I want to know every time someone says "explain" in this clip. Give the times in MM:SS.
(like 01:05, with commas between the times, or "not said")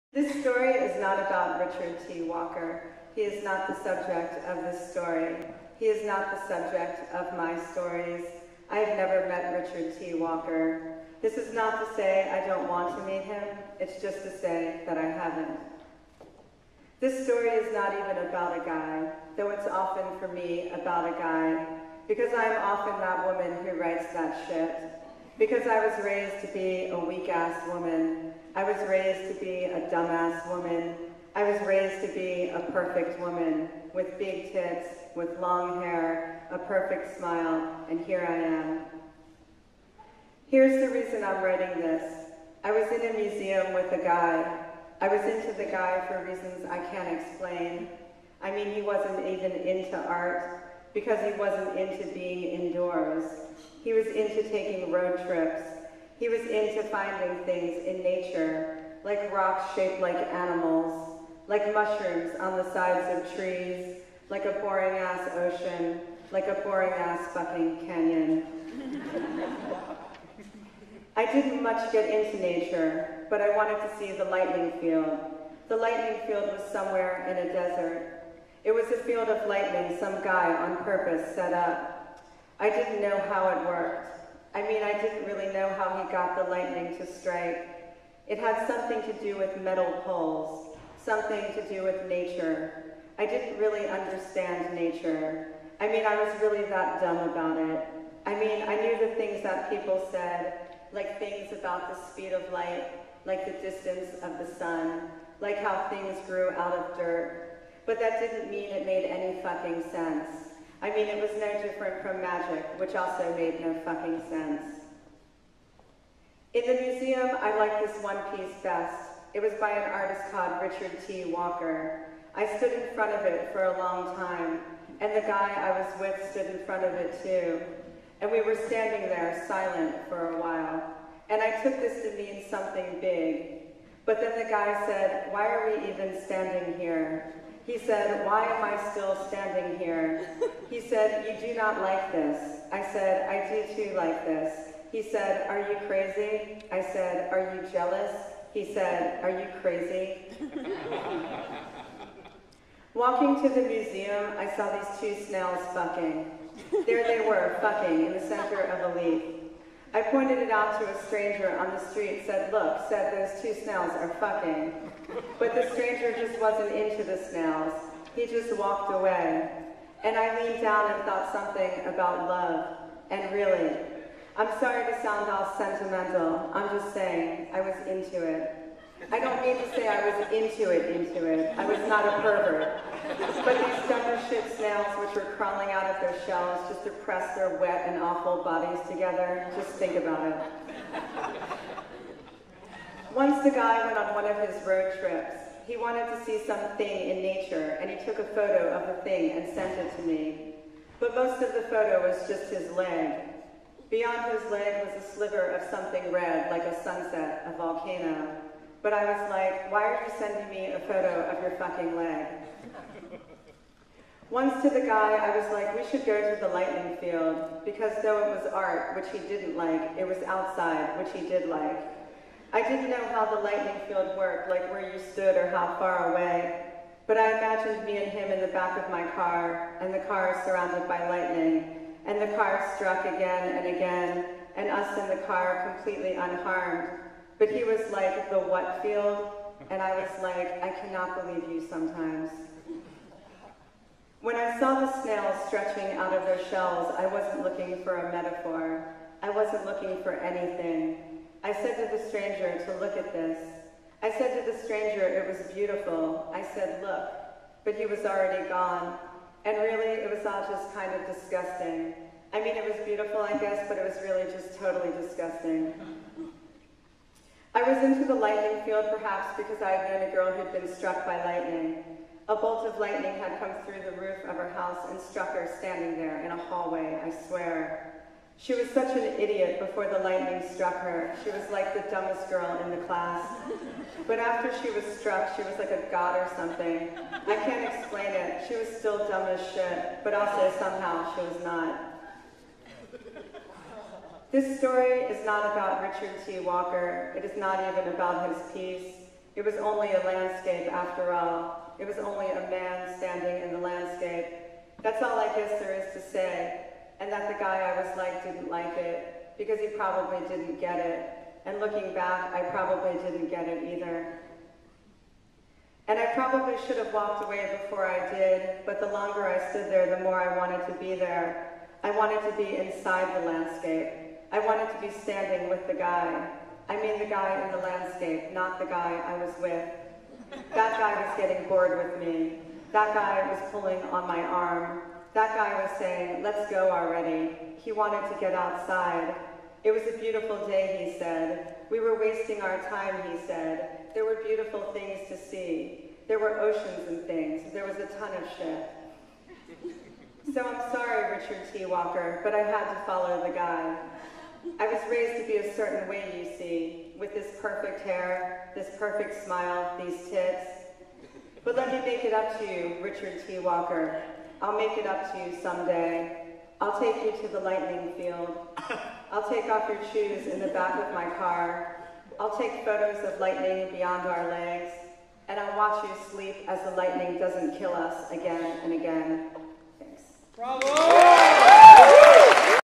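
00:47, 04:47.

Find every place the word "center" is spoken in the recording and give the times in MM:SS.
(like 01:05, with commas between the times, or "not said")
02:38.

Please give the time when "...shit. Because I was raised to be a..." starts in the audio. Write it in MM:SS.
00:24.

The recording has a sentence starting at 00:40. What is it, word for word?
Here's the reason I'm writing this.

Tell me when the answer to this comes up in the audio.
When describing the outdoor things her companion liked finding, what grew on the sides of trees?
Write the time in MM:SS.
01:01.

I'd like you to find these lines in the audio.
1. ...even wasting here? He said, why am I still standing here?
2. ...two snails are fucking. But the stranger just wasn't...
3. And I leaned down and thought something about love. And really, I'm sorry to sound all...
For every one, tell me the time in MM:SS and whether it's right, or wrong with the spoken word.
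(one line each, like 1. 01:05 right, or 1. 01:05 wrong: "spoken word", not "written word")
1. 02:15 wrong: "standing", not "wasting"
2. 02:43 right
3. 02:50 right.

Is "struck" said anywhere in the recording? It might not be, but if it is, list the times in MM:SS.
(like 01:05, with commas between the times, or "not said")
03:52, 04:30, 04:35, 04:40, 04:45.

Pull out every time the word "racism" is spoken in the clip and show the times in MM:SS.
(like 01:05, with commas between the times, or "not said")
not said.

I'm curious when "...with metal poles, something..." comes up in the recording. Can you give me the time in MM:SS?
01:29.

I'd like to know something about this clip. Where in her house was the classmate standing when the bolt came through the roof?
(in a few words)
A hallway.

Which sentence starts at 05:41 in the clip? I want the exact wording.
We were wasting our time, he said.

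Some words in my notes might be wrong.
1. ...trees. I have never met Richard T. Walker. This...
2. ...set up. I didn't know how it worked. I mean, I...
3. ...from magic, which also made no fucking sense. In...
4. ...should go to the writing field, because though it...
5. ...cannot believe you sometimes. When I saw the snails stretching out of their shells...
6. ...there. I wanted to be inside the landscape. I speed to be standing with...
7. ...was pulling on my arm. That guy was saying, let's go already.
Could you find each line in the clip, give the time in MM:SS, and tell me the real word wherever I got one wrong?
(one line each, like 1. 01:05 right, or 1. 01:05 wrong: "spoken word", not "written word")
1. 00:07 wrong: "stories", not "trees"
2. 01:21 right
3. 01:52 right
4. 03:35 wrong: "lightning", not "writing"
5. 04:00 right
6. 05:20 wrong: "wanted", not "speed"
7. 05:33 right.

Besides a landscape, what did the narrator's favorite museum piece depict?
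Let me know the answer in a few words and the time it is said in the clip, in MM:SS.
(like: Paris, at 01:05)
A man standing, at 05:02.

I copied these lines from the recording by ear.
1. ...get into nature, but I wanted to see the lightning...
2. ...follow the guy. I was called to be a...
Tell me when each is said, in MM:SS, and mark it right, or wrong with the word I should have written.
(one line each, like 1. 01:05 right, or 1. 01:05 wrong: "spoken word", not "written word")
1. 01:11 right
2. 05:52 wrong: "raised", not "called".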